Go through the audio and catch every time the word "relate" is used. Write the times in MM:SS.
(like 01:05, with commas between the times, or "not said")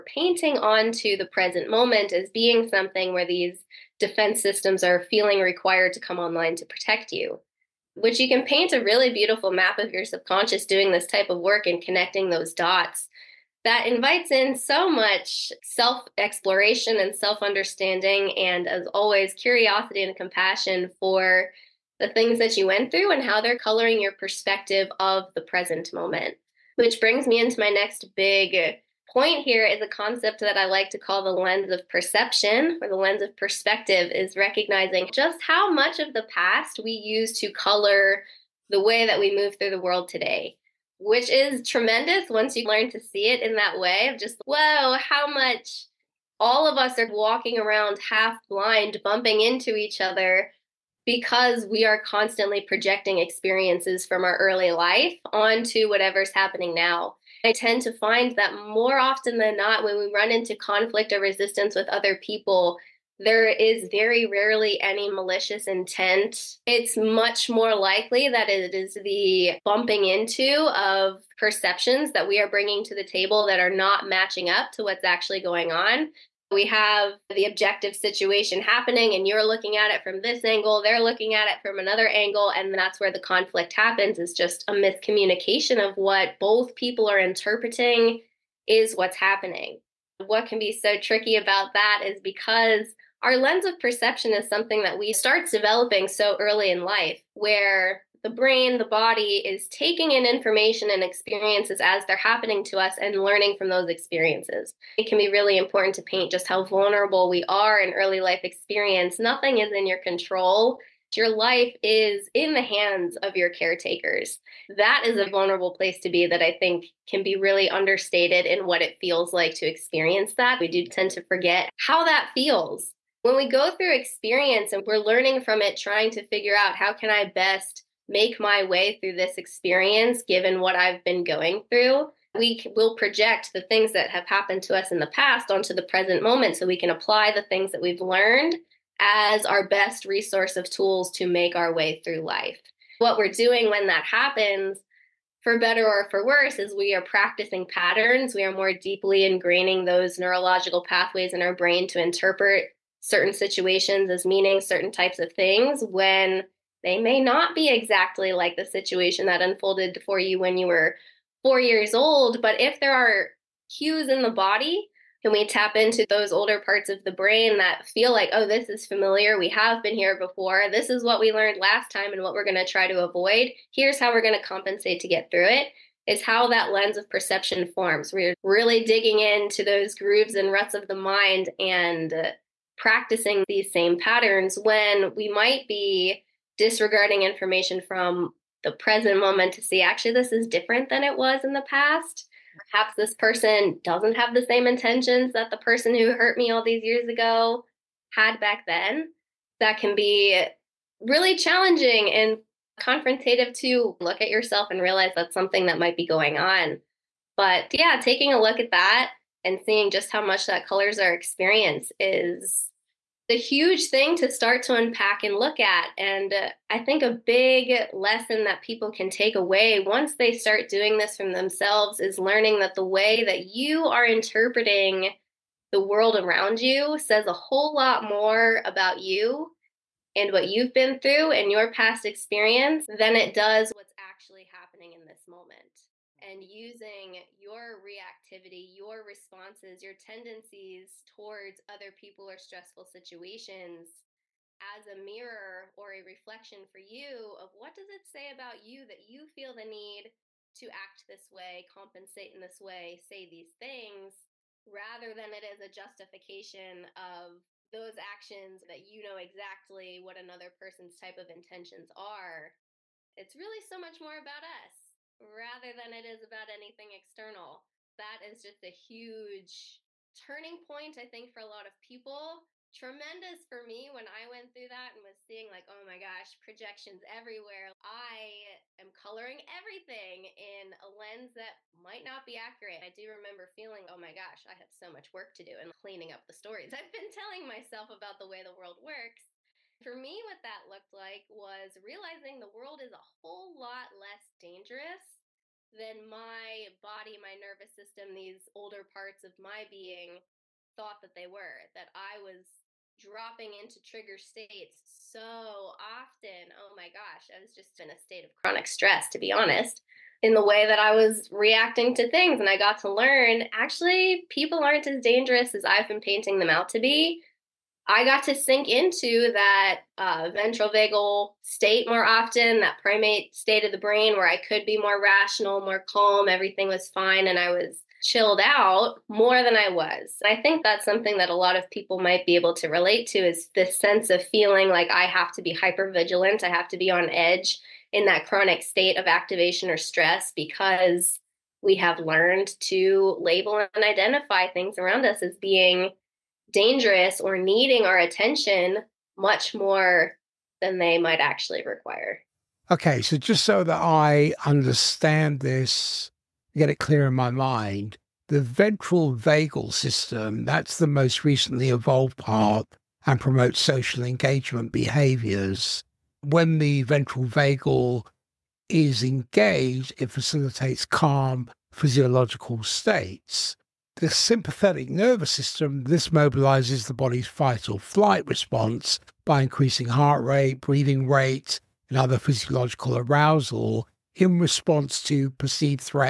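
05:32.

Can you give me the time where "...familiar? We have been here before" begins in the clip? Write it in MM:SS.
02:48.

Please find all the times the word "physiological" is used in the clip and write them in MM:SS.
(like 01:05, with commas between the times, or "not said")
06:11, 06:22.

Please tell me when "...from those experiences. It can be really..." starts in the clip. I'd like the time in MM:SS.
01:43.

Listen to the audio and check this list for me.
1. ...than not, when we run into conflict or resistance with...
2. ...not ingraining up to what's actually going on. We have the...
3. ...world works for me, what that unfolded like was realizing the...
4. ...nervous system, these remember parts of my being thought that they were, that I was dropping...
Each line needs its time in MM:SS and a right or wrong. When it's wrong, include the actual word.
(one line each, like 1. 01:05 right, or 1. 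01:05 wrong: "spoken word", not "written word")
1. 00:59 right
2. 01:13 wrong: "matching", not "ingraining"
3. 04:48 wrong: "looked", not "unfolded"
4. 04:57 wrong: "older", not "remember".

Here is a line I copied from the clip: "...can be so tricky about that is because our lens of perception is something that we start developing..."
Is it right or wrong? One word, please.
right.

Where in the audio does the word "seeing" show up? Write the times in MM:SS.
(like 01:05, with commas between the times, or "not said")
03:29, 04:35.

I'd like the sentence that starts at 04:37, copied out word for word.
I am coloring everything in a lens that might not be accurate.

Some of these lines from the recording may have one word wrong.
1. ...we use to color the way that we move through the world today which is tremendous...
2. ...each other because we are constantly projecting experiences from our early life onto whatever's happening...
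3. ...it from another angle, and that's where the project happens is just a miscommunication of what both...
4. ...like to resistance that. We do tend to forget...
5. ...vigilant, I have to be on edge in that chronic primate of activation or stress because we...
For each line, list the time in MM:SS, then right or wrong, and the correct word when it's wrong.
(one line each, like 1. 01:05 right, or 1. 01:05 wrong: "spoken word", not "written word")
1. 00:36 right
2. 00:49 right
3. 01:21 wrong: "conflict", not "project"
4. 01:59 wrong: "experience", not "resistance"
5. 05:35 wrong: "state", not "primate".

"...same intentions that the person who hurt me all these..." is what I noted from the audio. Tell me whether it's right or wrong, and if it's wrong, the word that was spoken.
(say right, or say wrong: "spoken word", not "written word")
right.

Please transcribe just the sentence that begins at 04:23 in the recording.
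It's really so much more about us rather than it is about anything external.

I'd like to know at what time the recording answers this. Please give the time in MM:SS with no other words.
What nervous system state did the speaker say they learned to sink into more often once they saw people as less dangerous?
05:20.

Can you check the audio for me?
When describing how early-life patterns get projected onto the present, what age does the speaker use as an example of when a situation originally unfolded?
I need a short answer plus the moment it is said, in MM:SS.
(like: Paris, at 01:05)
4, at 02:41.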